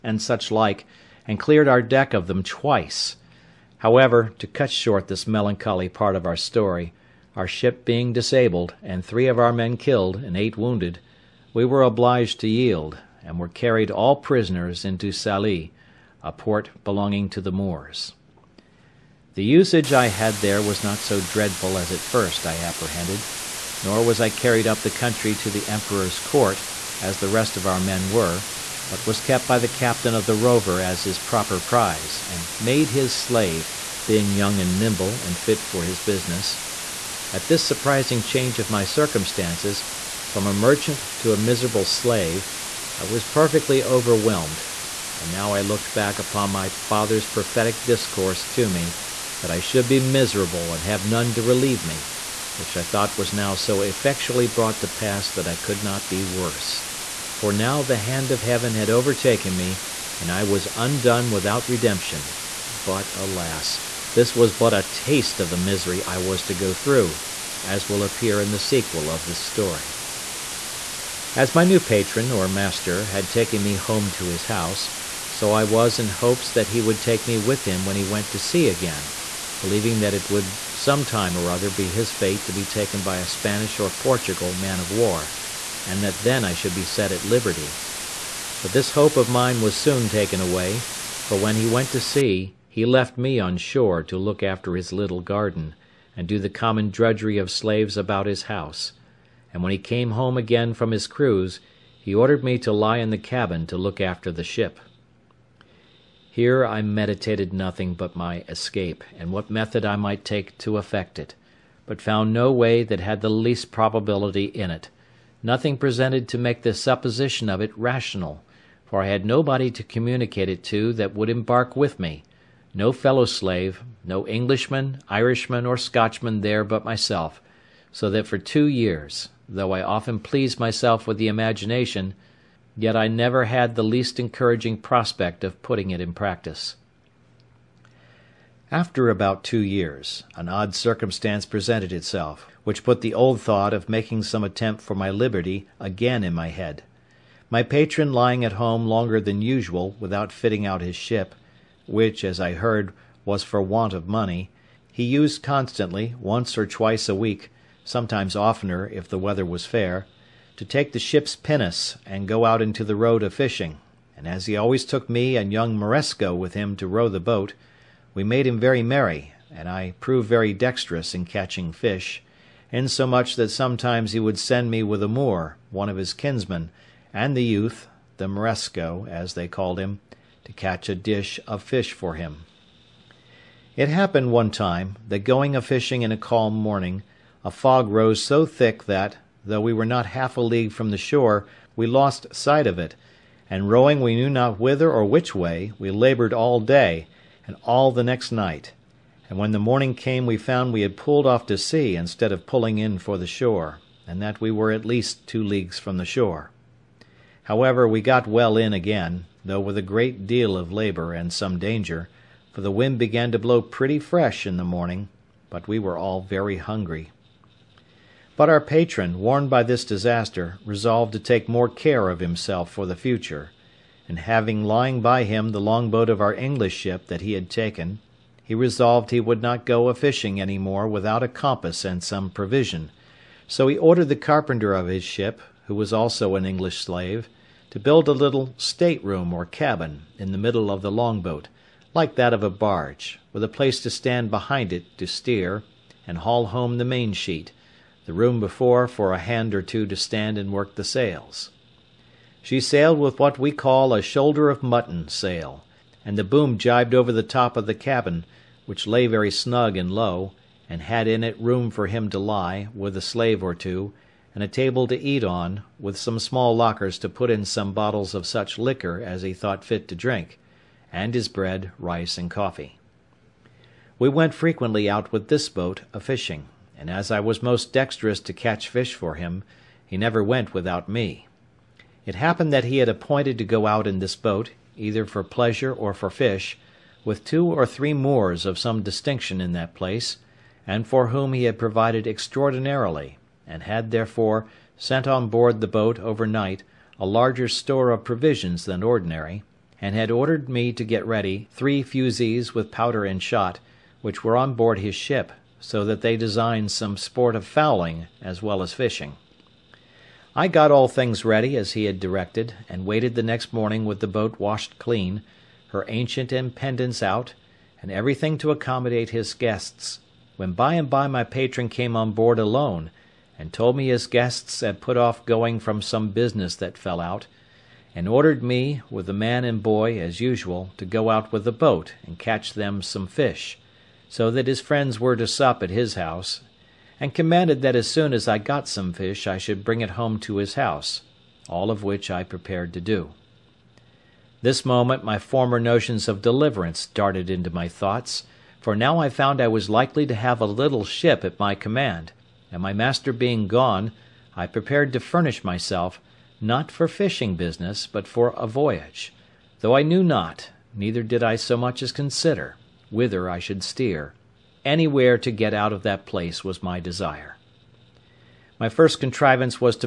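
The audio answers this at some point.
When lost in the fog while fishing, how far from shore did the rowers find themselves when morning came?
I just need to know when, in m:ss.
3:25.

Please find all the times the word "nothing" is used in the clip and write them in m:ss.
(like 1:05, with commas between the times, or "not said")
1:47, 1:55.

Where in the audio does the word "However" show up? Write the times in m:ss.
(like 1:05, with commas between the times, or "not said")
0:03, 3:27.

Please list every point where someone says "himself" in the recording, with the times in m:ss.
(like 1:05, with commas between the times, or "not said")
3:42.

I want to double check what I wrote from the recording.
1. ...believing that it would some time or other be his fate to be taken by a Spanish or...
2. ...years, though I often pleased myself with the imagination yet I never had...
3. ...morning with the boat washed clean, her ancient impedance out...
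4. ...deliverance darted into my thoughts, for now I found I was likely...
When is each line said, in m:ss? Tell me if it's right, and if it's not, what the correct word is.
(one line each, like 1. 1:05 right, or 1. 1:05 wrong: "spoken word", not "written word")
1. 1:19 right
2. 2:08 right
3. 5:13 right
4. 5:46 right.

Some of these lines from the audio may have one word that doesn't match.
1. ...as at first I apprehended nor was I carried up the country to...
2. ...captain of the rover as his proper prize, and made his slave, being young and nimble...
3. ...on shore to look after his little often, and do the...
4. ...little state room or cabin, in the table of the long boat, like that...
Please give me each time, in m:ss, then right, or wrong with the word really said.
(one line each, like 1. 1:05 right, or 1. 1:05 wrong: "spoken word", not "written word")
1. 0:21 right
2. 0:29 right
3. 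1:33 wrong: "garden", not "often"
4. 3:58 wrong: "middle", not "table".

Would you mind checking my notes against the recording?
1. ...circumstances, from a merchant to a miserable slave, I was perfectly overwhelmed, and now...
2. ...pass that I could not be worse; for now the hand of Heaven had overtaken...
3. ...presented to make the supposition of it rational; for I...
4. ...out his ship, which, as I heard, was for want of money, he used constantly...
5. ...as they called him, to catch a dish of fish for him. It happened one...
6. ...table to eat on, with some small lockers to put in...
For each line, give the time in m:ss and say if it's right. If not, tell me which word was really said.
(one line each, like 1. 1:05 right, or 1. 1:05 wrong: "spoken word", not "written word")
1. 0:38 right
2. 0:54 right
3. 1:55 right
4. 2:30 right
5. 2:59 right
6. 4:24 right.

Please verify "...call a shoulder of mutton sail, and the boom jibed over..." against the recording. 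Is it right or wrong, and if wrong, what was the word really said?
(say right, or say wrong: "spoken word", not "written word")
right.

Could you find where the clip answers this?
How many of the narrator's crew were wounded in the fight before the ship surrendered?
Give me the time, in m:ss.
0:10.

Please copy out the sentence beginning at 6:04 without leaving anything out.
Anywhere to get out of that place was my desire.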